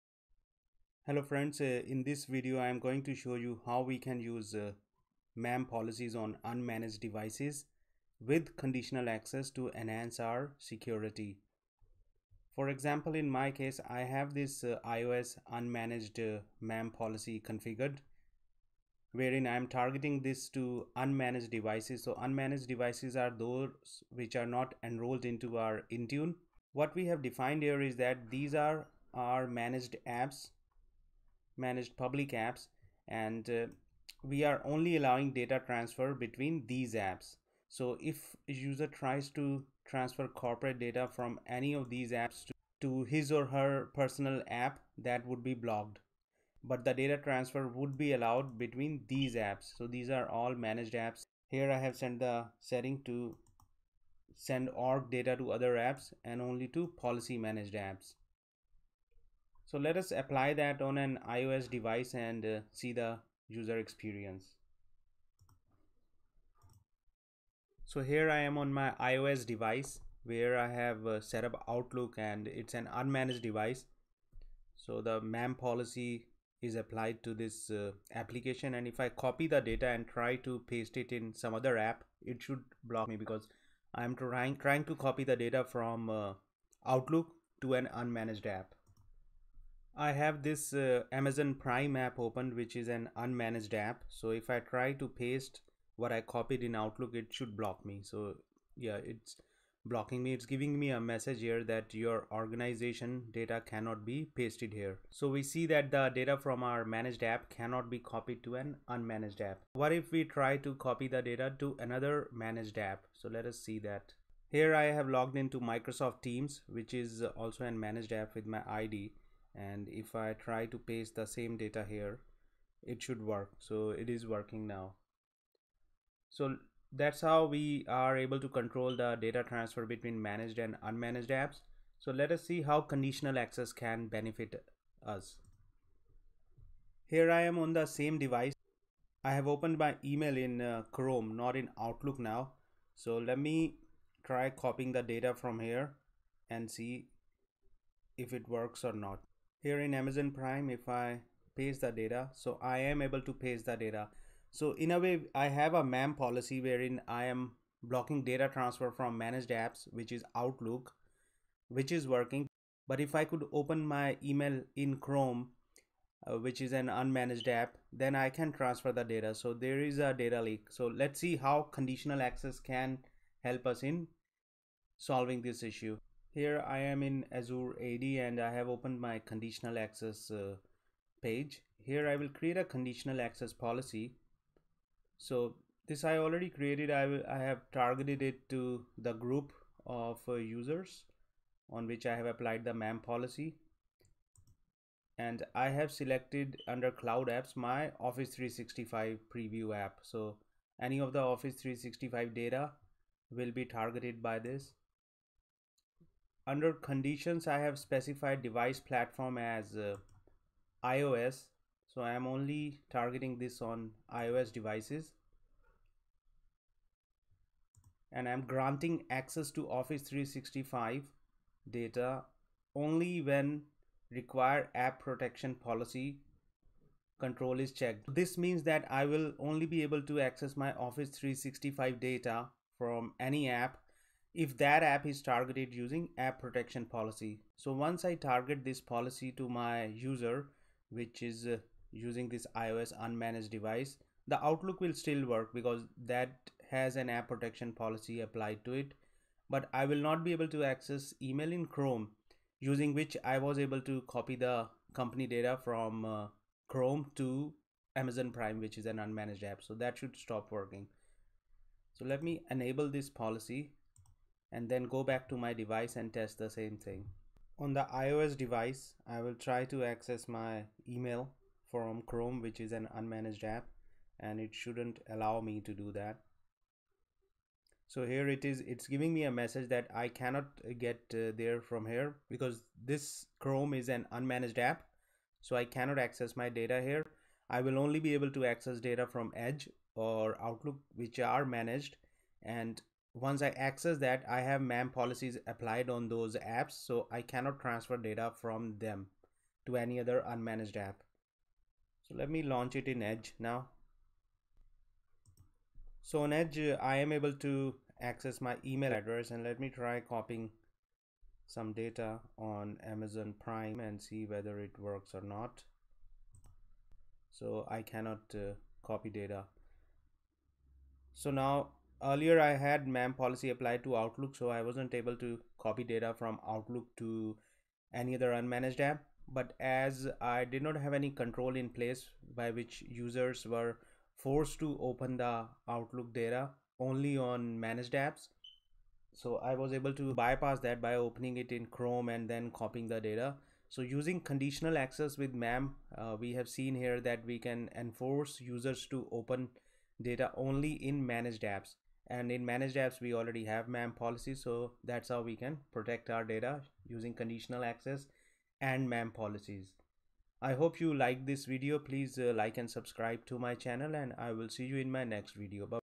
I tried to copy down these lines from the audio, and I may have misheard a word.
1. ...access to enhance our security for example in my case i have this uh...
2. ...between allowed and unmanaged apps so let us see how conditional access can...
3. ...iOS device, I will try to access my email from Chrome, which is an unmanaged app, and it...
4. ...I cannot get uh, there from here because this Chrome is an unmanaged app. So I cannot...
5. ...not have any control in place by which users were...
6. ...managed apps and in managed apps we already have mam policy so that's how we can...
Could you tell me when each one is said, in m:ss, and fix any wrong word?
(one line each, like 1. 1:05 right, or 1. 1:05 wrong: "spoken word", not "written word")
1. 0:09 right
2. 2:09 wrong: "managed", not "allowed"
3. 4:27 right
4. 4:39 right
5. 5:30 right
6. 5:51 right.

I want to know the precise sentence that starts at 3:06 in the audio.
I, will, I have targeted it to the group of uh, users on which I have applied the MAM policy.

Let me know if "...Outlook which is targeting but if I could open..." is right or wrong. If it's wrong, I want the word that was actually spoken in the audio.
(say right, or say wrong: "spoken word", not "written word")
wrong: "working", not "targeting".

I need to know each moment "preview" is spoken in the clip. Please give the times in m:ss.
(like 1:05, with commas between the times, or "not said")
3:19.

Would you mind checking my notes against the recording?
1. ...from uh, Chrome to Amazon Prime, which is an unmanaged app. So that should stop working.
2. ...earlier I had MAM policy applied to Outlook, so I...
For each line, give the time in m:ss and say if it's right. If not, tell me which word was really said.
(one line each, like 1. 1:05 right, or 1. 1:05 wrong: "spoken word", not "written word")
1. 4:15 right
2. 5:22 right.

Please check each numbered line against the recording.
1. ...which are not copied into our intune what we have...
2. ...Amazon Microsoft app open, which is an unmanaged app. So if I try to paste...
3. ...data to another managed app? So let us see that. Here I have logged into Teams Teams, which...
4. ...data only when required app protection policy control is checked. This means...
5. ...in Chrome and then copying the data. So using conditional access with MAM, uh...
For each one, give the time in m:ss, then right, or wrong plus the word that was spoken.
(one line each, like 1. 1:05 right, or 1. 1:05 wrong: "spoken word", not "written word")
1. 0:24 wrong: "enrolled", not "copied"
2. 1:31 wrong: "Prime", not "Microsoft"
3. 1:51 wrong: "Microsoft", not "Teams"
4. 3:41 right
5. 5:41 right.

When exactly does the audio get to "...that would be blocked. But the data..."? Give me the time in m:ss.
0:44.